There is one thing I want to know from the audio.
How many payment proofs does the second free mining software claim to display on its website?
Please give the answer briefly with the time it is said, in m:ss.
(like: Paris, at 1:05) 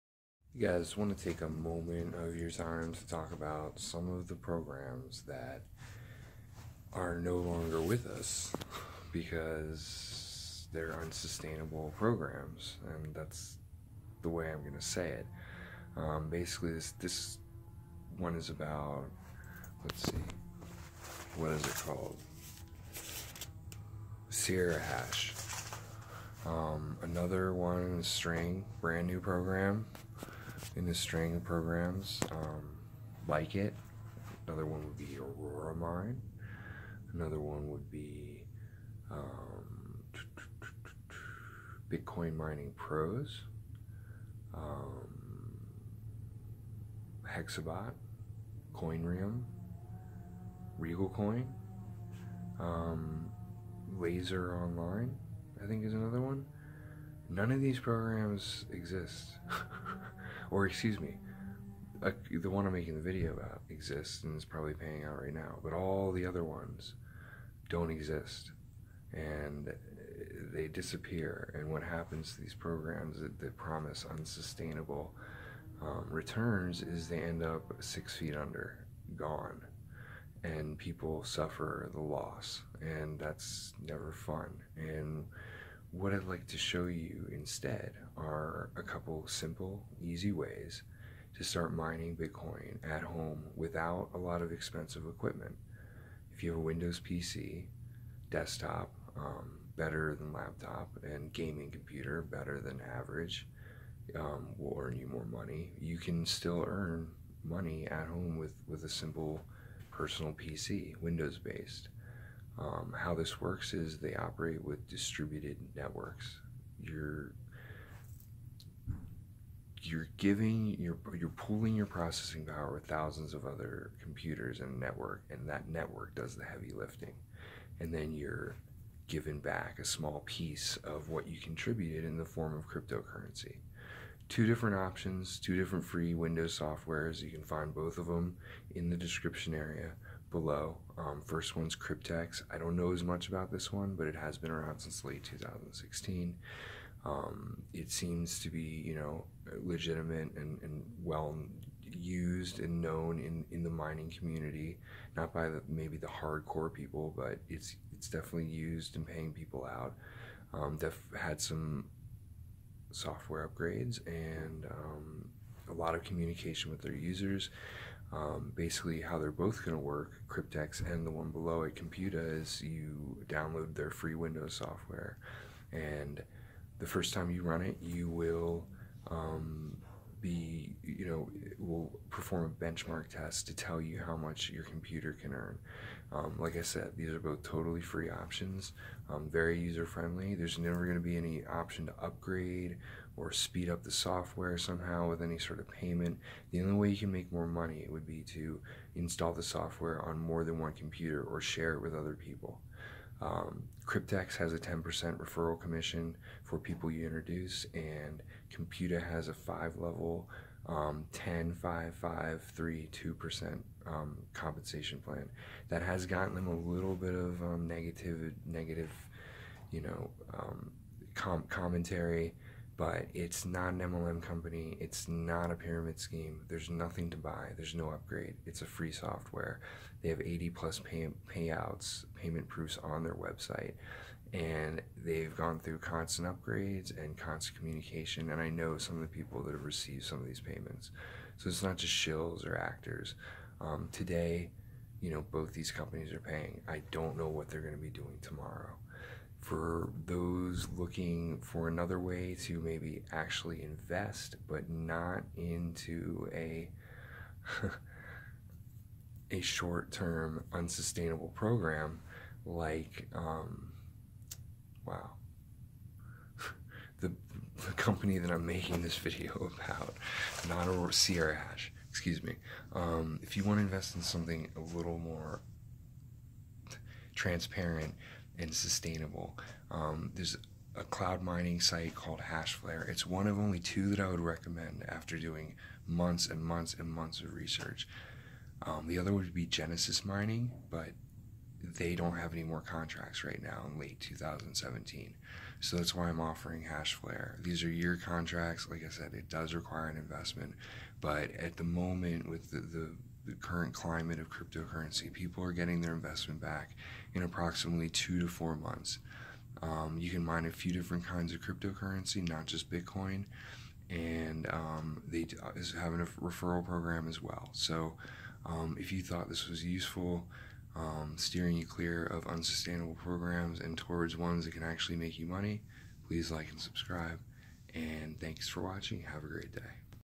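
80 plus, at 3:50.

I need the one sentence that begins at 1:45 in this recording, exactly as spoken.
You can still earn money at home with, with a simple personal PC, Windows based.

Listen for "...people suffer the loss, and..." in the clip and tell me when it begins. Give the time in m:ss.
1:20.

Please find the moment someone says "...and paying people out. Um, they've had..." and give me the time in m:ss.
2:38.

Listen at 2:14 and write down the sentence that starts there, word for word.
Two different options, two different free Windows softwares.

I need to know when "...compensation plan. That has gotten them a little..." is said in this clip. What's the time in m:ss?
3:34.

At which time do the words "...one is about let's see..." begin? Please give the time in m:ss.
0:18.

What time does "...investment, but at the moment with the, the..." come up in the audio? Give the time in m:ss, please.
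4:59.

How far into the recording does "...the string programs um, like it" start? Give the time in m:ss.
0:30.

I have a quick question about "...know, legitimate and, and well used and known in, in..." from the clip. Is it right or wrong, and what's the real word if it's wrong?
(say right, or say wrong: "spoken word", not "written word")
right.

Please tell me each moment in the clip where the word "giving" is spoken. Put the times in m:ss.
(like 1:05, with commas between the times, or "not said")
2:00.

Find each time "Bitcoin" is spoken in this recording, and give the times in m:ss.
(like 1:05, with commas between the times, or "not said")
0:41, 1:32, 5:12.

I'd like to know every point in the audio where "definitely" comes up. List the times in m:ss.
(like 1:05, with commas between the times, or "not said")
2:38.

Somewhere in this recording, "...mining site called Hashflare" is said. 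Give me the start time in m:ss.
4:41.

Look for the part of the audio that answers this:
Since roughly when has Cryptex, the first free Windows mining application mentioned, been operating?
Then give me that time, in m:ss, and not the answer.
2:25.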